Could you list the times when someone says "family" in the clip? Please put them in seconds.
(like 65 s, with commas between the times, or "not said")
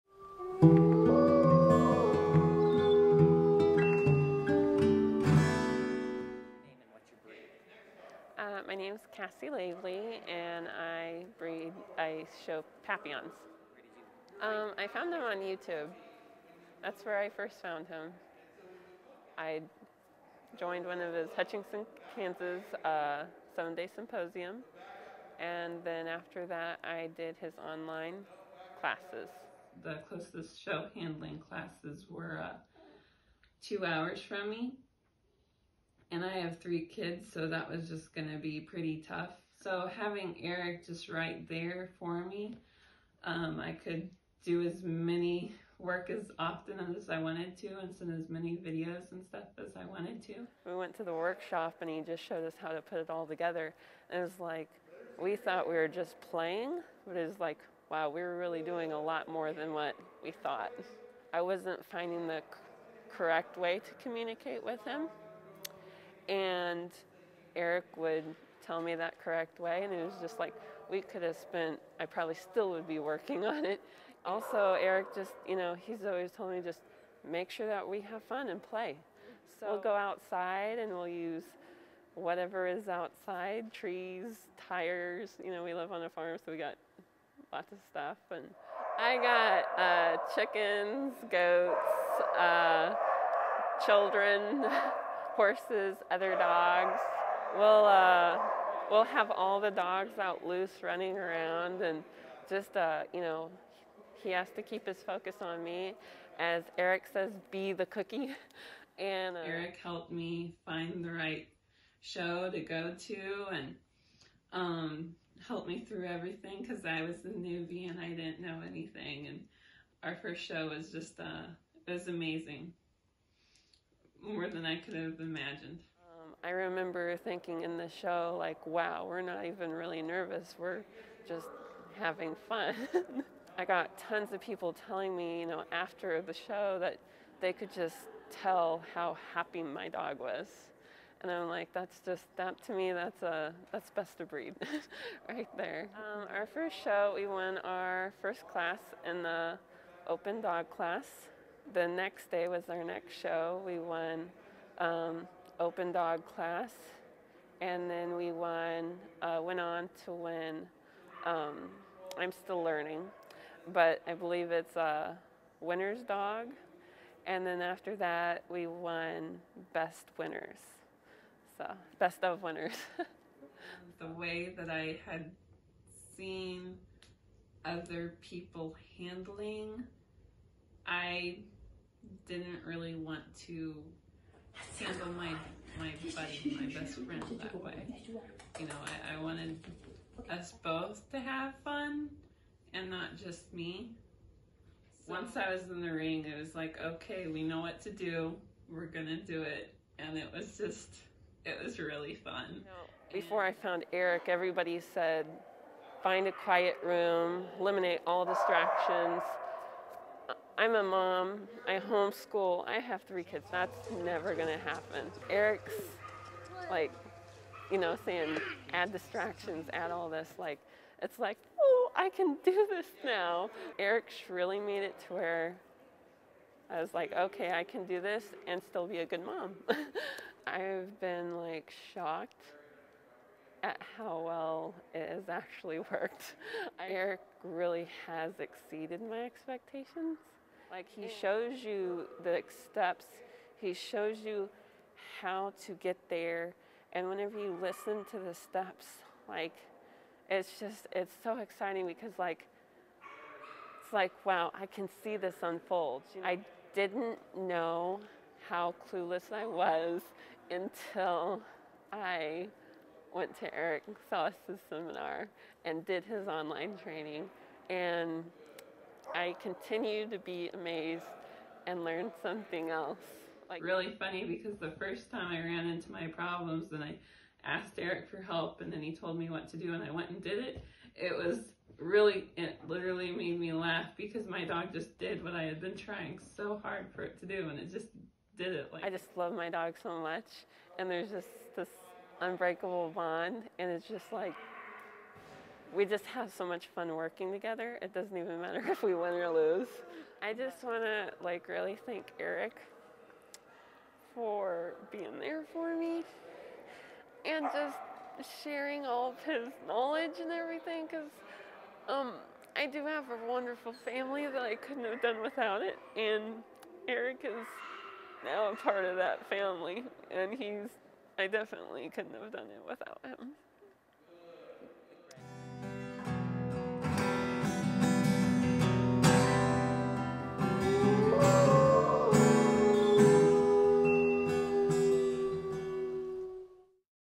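313 s, 319 s.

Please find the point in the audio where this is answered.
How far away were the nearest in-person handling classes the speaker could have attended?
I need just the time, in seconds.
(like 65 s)
33 s.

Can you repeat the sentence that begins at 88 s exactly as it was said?
And I got uh, chickens, goats, uh, children.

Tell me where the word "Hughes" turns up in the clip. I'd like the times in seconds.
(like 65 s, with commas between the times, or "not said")
not said.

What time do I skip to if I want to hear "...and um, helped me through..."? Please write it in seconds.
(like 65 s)
113 s.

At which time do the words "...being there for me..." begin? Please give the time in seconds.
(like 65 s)
304 s.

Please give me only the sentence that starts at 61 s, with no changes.
I wasn't finding the correct way to communicate with him.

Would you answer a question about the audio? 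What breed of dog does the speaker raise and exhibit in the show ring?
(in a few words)
Papillons.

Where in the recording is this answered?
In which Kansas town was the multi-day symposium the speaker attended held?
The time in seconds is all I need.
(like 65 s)
21 s.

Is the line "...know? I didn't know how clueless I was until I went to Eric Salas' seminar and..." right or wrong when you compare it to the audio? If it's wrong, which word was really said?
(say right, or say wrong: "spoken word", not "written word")
right.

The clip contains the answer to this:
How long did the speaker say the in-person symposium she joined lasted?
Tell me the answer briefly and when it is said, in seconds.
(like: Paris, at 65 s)
7 days, at 23 s.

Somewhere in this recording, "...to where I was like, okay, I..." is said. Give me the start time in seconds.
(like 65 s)
225 s.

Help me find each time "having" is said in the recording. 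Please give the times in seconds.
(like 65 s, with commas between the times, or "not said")
39 s, 131 s.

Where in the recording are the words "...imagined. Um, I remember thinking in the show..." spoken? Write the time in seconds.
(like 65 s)
125 s.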